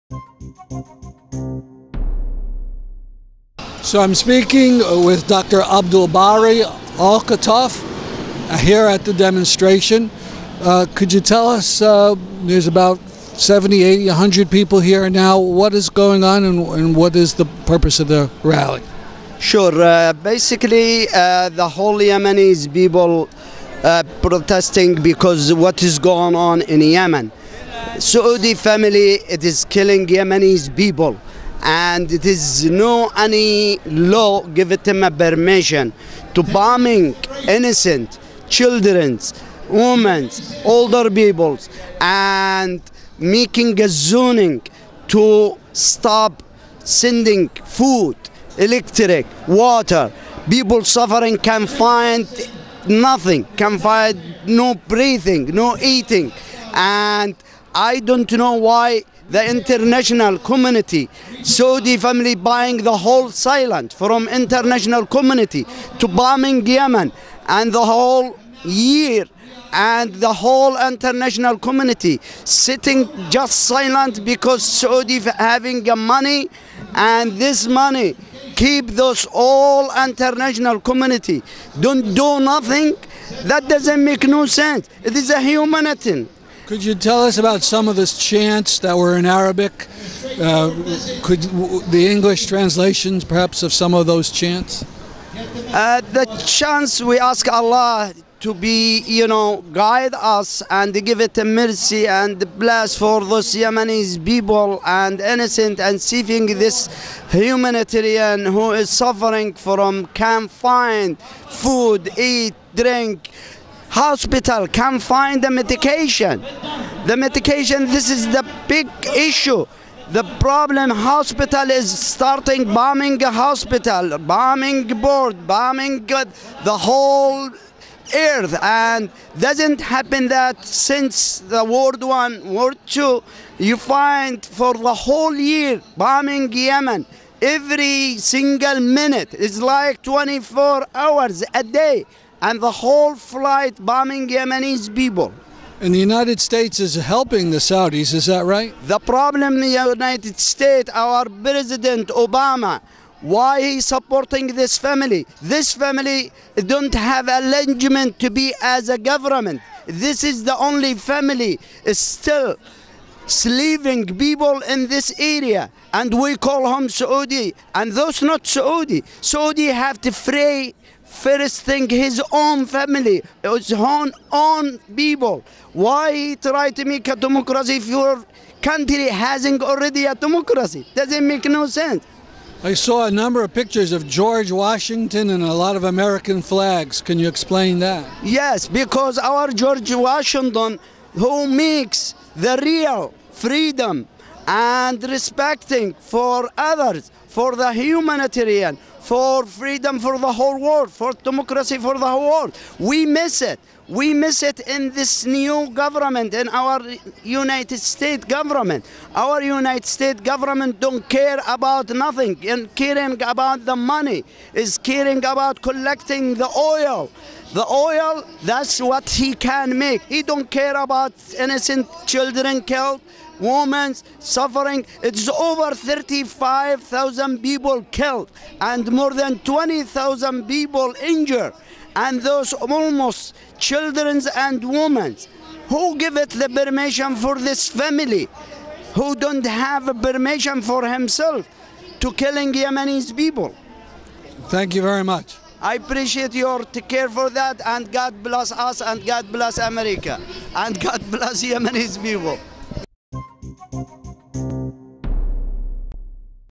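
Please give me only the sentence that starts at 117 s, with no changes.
The medication, this is the big issue.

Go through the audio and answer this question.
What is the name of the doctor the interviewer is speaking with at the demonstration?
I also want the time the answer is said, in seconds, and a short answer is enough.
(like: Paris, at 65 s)
Abdul Bari Al Khataf, at 5 s.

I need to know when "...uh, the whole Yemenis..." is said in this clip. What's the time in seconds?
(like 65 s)
21 s.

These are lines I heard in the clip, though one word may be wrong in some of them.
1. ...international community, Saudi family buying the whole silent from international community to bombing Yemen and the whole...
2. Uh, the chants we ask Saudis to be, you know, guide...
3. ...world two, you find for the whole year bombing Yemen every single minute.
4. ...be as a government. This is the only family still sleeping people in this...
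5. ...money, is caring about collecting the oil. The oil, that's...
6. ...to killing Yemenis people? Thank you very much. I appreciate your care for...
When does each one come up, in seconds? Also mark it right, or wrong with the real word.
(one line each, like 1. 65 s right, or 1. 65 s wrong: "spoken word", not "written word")
1. 59 s right
2. 95 s wrong: "Allah", not "Saudis"
3. 132 s right
4. 158 s right
5. 213 s right
6. 242 s right.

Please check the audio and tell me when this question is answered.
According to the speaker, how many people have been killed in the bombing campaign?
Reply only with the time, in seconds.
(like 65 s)
225 s.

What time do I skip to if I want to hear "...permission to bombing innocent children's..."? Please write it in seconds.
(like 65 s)
35 s.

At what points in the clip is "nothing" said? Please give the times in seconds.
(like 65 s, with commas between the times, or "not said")
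52 s, 82 s, 211 s.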